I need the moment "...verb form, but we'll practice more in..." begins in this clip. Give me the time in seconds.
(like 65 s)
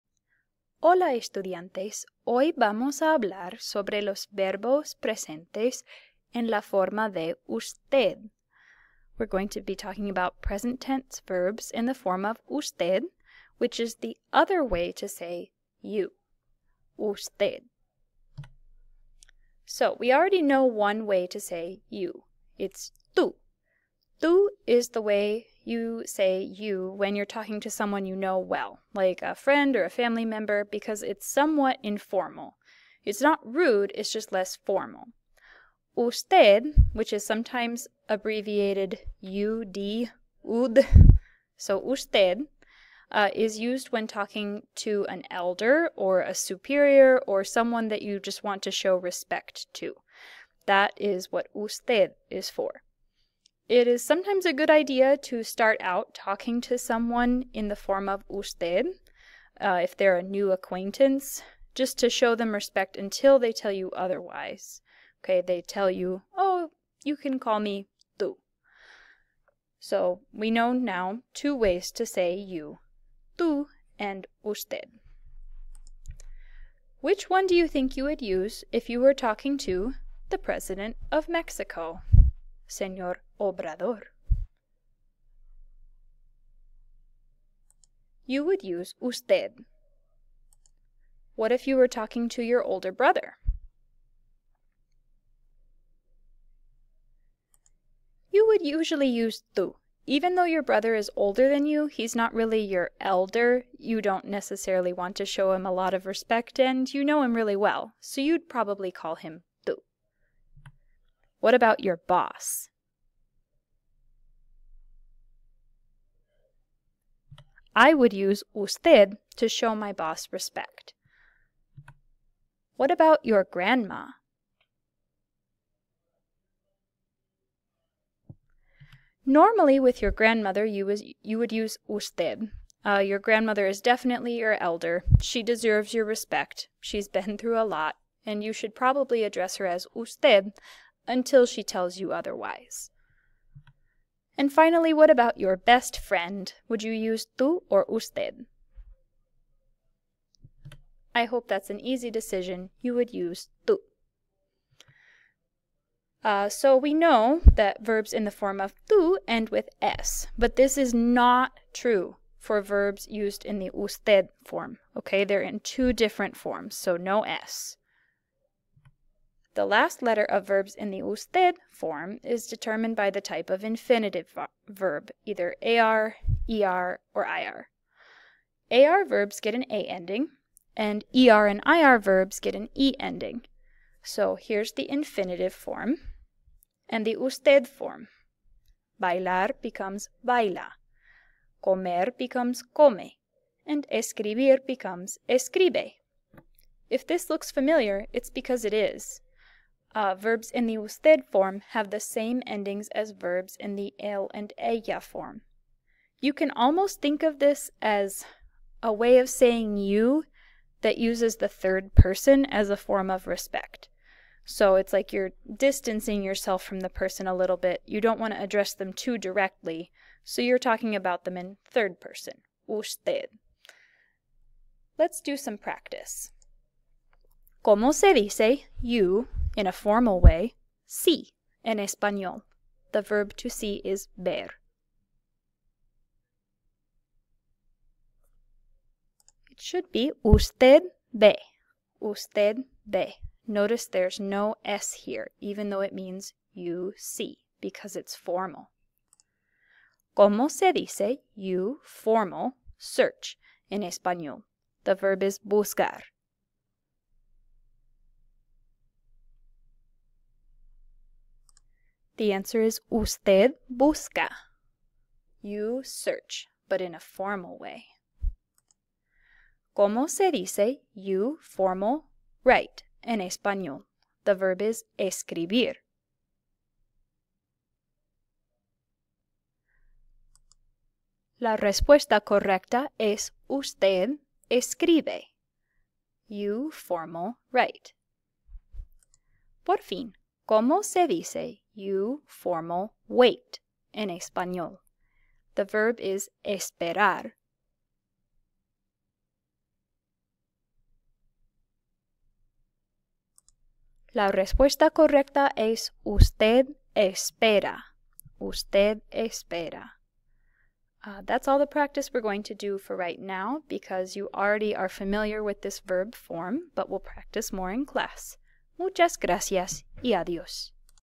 315 s.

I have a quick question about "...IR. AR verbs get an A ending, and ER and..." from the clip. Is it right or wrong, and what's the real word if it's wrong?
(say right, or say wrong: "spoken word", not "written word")
right.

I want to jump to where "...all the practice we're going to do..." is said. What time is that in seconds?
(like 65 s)
311 s.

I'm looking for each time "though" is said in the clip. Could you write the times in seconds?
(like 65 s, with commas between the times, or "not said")
100 s, 245 s.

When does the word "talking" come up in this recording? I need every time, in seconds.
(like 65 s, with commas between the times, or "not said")
9 s, 27 s, 44 s, 56 s, 79 s, 91 s, 220 s.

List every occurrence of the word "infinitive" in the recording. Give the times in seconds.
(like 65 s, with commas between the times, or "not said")
173 s, 184 s.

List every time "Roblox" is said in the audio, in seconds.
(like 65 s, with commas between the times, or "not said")
not said.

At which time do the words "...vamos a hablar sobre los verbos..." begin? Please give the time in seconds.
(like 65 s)
2 s.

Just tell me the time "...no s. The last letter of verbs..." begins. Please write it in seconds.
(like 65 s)
166 s.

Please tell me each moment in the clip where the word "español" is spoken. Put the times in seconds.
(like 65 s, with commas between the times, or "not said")
231 s, 253 s, 273 s, 294 s.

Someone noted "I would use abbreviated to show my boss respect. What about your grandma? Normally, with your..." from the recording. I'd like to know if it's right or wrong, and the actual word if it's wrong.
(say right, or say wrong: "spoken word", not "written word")
wrong: "usted", not "abbreviated".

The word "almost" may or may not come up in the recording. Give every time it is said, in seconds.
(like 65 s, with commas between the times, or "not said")
206 s.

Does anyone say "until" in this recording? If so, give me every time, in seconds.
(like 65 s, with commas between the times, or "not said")
62 s, 141 s.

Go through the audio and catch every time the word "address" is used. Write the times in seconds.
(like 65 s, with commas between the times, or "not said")
139 s, 218 s.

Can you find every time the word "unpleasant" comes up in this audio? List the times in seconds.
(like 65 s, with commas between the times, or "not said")
not said.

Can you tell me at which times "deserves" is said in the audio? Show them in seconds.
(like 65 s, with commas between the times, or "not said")
135 s.